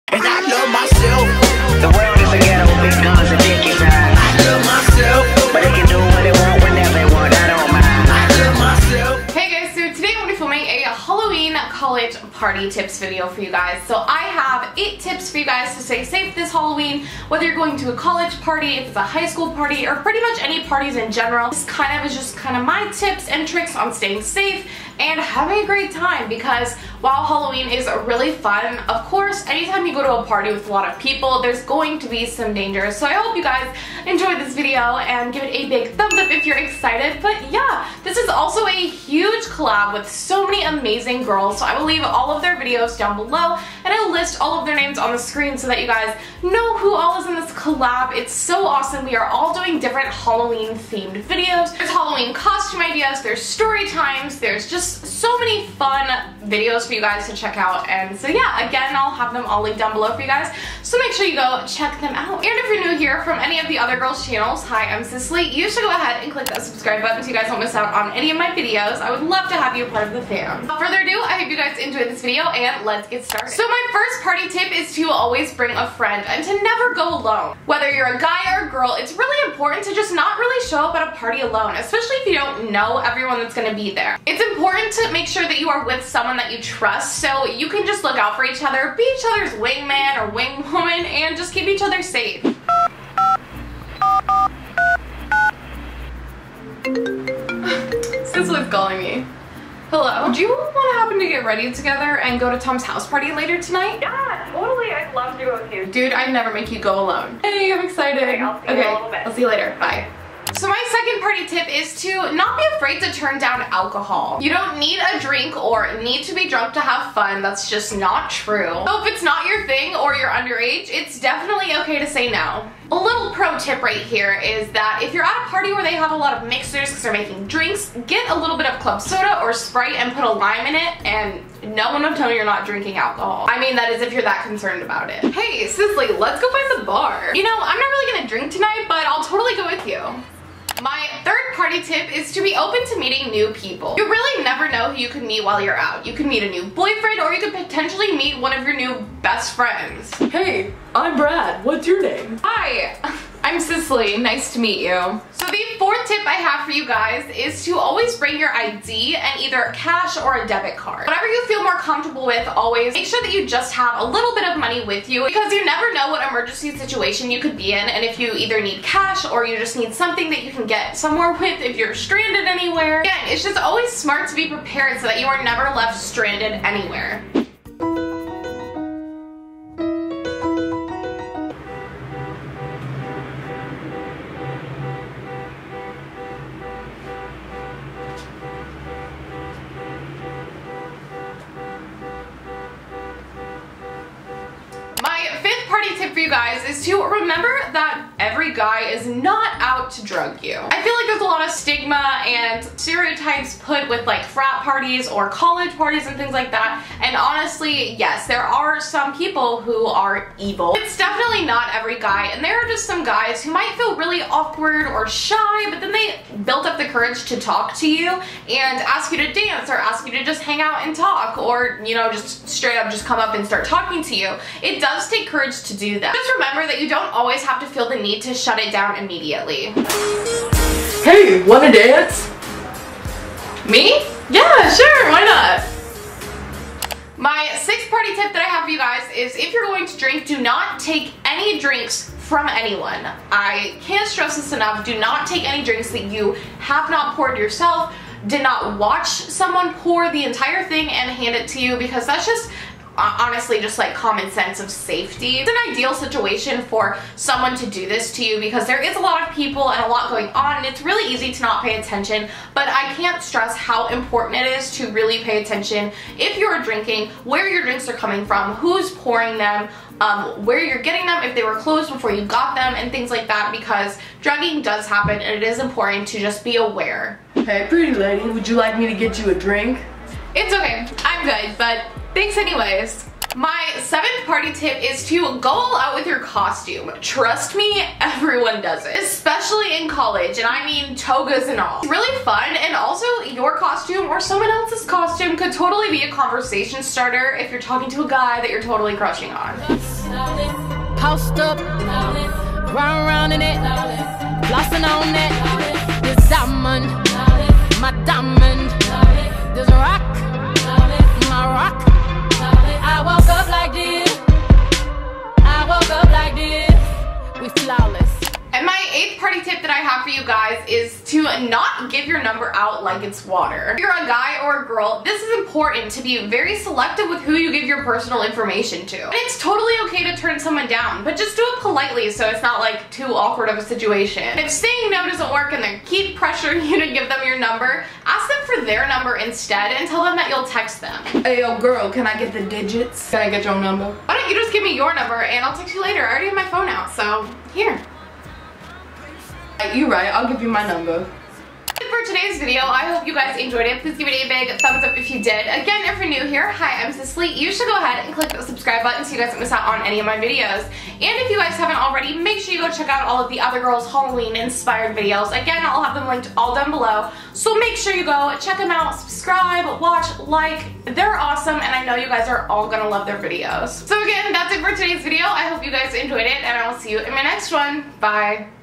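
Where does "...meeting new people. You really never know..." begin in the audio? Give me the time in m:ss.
2:22.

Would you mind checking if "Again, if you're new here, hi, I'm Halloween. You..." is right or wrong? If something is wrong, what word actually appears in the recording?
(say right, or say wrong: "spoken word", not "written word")
wrong: "Cicily", not "Halloween".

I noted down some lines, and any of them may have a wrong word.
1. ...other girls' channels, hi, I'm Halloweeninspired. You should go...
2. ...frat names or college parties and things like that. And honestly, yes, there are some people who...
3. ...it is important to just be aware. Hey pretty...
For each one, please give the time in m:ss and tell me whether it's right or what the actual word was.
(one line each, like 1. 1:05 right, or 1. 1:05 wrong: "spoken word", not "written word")
1. 1:03 wrong: "Cicily", not "Halloweeninspired"
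2. 3:24 wrong: "parties", not "names"
3. 4:35 right.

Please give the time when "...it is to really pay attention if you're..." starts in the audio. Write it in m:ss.
4:24.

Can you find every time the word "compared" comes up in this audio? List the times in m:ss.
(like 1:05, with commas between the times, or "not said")
not said.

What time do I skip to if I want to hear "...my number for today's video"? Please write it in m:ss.
5:50.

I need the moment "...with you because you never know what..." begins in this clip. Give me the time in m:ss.
2:44.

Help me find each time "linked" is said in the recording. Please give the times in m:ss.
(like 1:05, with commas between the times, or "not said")
0:59, 6:06.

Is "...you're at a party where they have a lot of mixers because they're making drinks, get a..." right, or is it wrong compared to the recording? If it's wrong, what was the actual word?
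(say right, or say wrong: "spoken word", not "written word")
right.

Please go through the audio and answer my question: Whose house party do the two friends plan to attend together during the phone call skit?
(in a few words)
Tom's.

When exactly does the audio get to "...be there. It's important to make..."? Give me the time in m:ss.
1:23.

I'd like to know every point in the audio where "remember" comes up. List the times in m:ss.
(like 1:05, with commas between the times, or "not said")
3:17, 3:46.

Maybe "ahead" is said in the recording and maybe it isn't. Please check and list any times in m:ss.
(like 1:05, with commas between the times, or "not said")
1:05, 5:57.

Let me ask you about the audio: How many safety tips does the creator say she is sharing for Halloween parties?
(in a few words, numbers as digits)
8.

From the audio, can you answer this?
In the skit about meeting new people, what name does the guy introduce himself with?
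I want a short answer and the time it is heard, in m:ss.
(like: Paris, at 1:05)
Brad, at 2:31.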